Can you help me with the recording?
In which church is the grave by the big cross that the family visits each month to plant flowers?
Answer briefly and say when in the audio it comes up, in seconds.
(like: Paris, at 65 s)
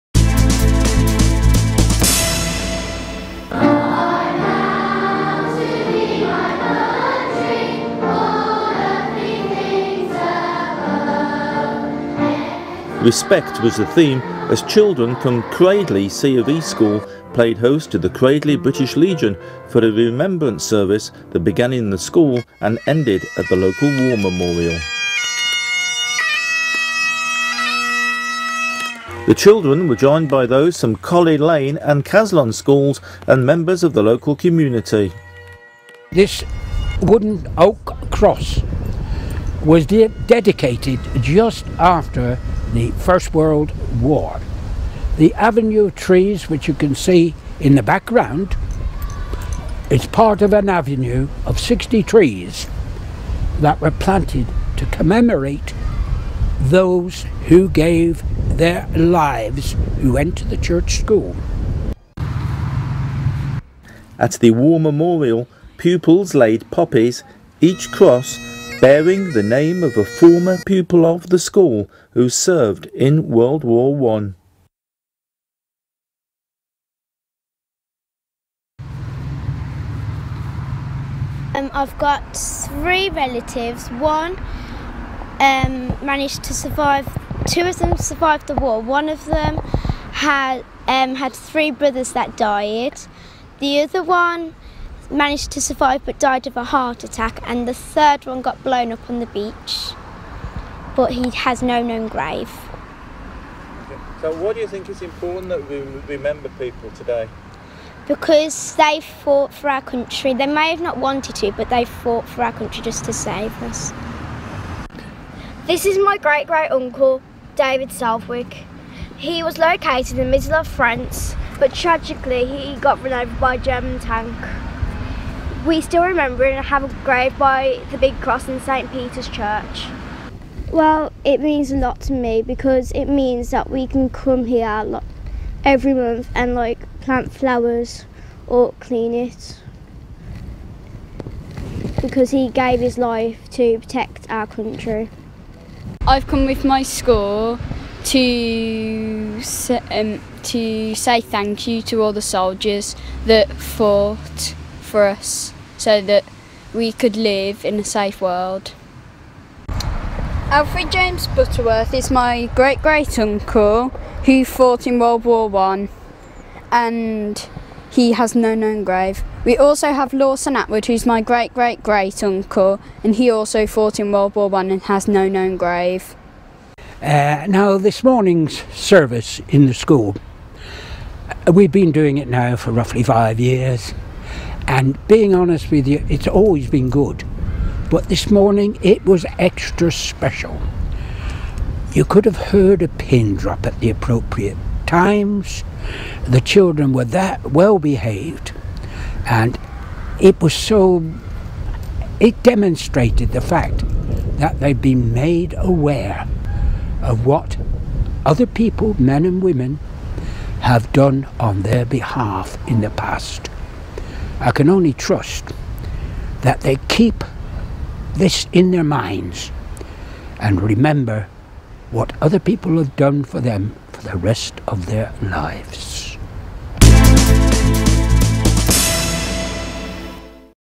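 St Peter's Church, at 128 s.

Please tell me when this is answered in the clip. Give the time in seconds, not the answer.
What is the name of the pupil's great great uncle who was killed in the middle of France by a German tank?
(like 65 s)
117 s.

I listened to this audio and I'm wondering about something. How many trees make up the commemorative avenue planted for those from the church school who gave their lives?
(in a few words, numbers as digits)
60.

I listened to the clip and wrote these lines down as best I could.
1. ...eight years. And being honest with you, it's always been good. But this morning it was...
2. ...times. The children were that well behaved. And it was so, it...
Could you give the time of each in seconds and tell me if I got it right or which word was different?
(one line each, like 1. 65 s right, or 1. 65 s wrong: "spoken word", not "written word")
1. 183 s wrong: "five", not "eight"
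2. 194 s right.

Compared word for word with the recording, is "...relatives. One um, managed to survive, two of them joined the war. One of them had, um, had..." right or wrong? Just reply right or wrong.
wrong.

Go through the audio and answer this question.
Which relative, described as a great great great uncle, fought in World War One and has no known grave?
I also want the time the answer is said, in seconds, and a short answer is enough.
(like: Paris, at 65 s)
Lawson Atwood, at 170 s.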